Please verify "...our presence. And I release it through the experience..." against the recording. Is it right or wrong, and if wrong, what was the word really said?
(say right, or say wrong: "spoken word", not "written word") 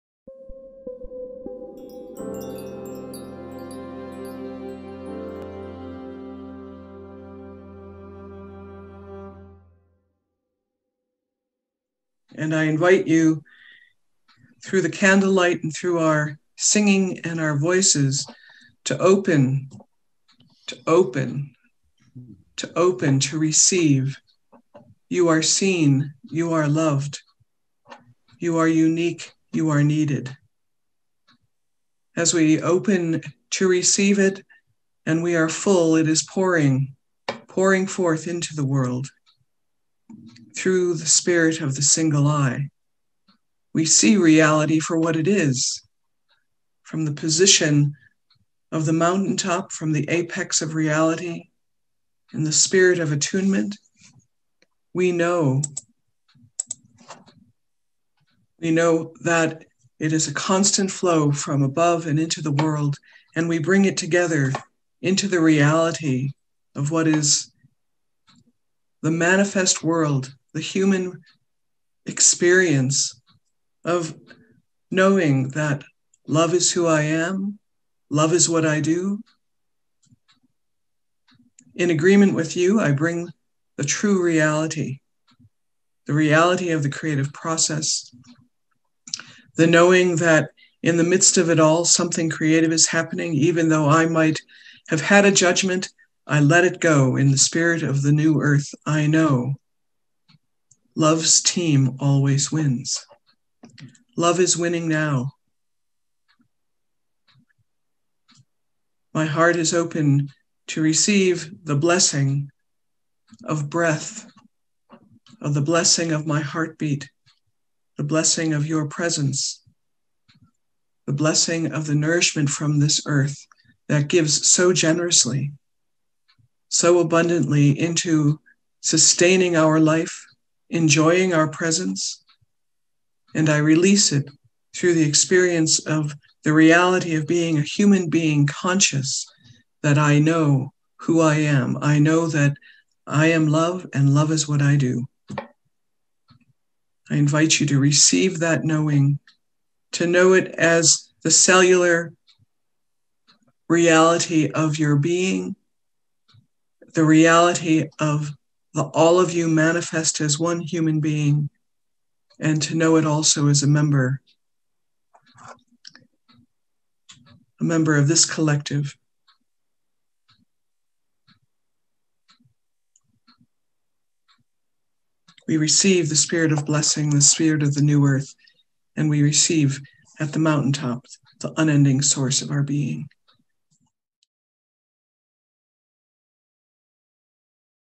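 right.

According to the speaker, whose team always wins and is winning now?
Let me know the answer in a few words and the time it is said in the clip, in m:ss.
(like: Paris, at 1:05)
love's team, at 1:40.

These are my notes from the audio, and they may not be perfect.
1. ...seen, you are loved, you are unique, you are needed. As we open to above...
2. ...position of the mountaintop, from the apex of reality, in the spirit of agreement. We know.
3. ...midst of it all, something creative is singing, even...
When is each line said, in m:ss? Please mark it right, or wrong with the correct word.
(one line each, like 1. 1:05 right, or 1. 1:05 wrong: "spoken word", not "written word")
1. 0:25 wrong: "receive", not "above"
2. 0:47 wrong: "attunement", not "agreement"
3. 1:31 wrong: "happening", not "singing".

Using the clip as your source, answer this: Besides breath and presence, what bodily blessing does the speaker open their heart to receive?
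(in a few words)
heartbeat.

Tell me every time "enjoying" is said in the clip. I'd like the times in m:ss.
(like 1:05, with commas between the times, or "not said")
2:10.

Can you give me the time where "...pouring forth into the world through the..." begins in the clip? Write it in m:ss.
0:37.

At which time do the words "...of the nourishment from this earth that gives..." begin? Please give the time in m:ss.
2:01.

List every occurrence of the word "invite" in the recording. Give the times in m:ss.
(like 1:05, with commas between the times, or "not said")
0:12, 2:27.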